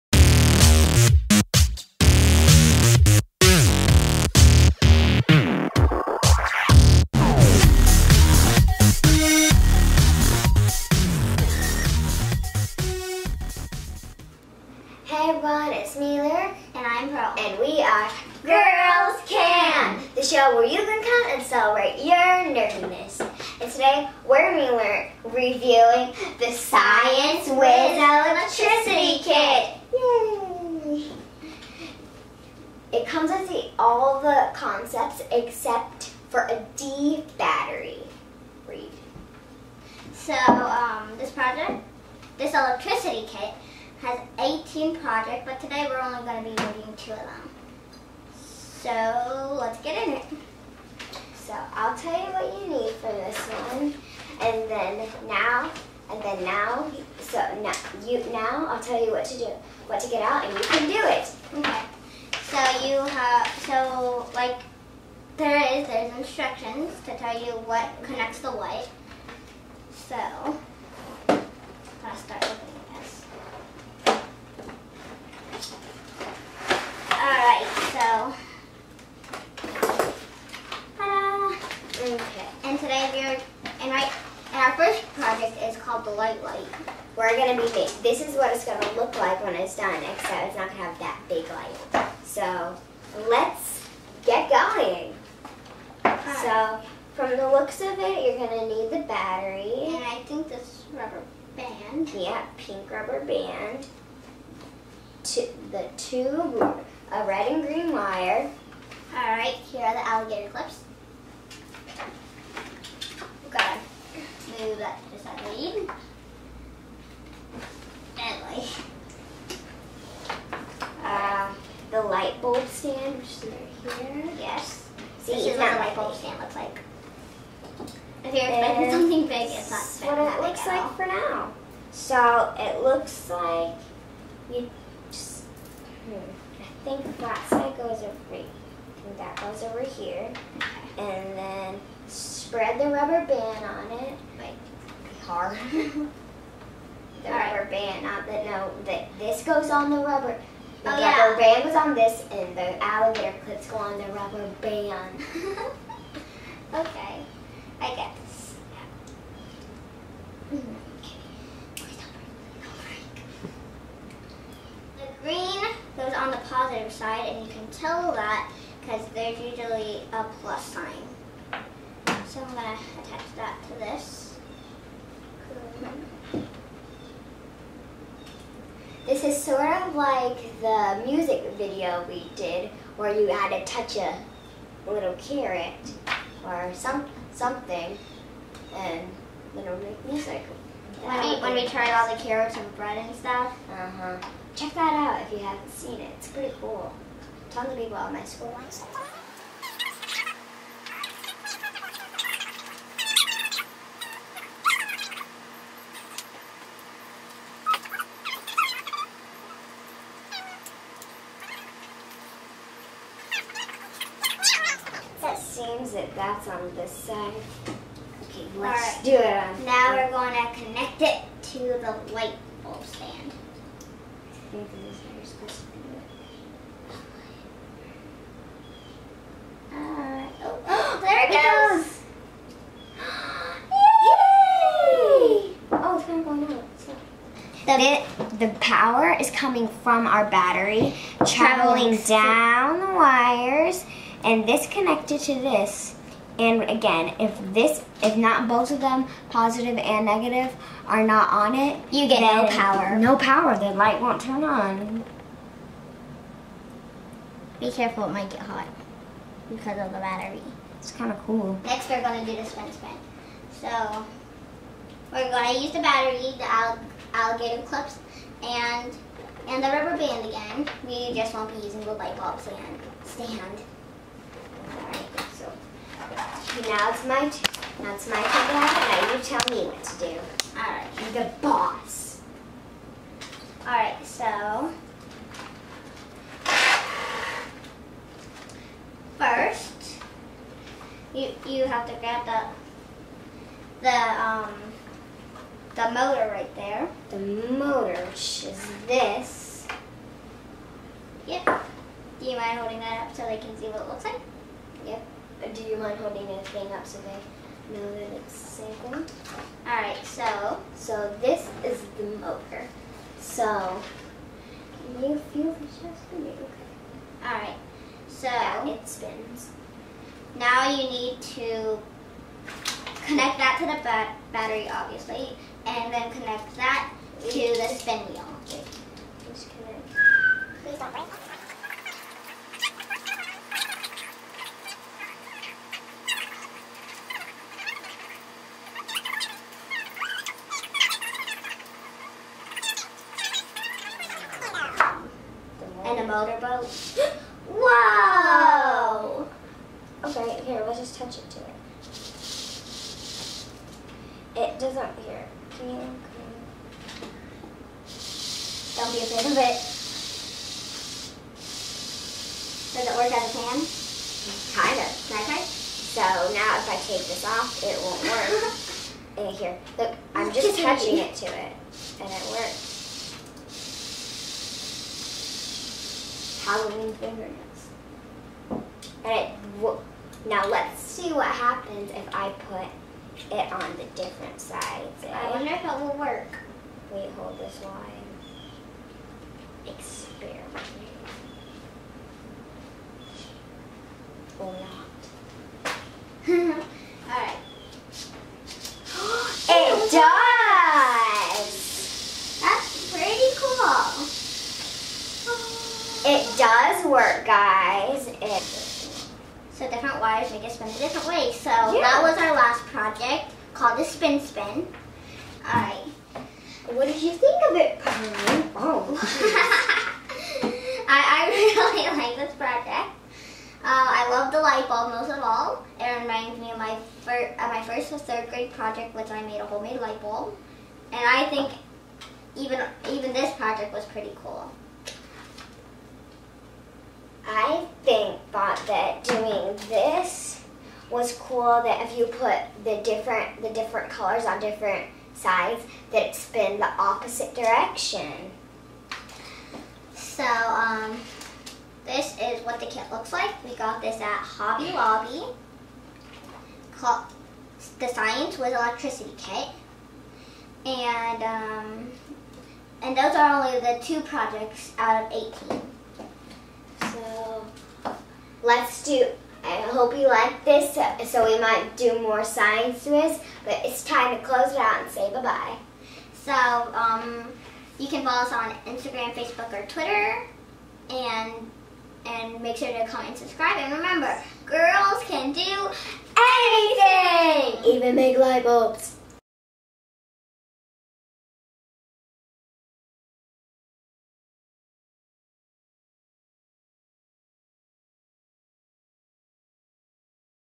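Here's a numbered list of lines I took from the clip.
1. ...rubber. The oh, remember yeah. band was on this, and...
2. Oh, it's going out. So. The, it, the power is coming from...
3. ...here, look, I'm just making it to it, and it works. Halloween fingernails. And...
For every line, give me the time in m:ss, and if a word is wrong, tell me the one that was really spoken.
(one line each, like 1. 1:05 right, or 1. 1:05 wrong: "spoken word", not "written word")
1. 2:29 wrong: "rubber", not "remember"
2. 3:55 right
3. 6:09 wrong: "touching", not "making".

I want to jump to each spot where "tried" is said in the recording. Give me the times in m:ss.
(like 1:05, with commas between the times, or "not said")
3:11.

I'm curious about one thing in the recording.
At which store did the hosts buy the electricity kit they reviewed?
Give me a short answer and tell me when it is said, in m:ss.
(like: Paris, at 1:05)
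Hobby Lobby, at 7:34.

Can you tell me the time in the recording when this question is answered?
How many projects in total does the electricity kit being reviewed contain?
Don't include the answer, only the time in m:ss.
0:44.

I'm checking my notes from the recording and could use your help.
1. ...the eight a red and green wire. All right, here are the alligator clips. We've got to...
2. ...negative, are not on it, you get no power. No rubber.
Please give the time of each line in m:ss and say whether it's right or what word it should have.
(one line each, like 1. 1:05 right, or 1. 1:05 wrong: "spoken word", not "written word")
1. 1:45 wrong: "two", not "eight"
2. 4:10 wrong: "power", not "rubber".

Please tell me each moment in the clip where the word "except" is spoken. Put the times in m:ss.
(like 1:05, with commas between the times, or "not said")
0:35, 1:30.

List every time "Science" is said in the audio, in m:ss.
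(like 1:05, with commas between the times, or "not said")
0:26, 7:37, 7:52.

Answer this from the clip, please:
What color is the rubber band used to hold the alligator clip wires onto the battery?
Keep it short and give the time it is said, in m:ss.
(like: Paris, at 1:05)
Pink, at 1:42.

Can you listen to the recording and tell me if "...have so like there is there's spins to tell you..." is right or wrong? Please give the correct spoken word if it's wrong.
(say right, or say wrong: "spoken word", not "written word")
wrong: "instructions", not "spins".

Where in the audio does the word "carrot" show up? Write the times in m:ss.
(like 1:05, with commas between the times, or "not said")
3:05, 3:12.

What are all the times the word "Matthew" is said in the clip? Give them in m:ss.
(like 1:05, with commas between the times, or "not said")
not said.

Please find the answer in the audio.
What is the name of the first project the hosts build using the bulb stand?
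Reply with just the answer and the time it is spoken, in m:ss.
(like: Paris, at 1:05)
The light light, at 1:26.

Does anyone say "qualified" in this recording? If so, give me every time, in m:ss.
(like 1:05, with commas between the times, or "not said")
not said.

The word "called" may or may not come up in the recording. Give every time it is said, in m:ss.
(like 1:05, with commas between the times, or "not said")
1:25, 6:53, 7:36.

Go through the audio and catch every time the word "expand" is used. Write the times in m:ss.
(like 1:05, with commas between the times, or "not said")
not said.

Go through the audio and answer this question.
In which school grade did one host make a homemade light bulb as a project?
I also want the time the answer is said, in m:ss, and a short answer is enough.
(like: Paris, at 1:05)
Third grade, at 7:08.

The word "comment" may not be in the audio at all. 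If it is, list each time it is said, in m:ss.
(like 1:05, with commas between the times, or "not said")
8:02.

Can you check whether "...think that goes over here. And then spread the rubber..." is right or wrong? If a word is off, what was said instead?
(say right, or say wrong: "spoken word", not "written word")
right.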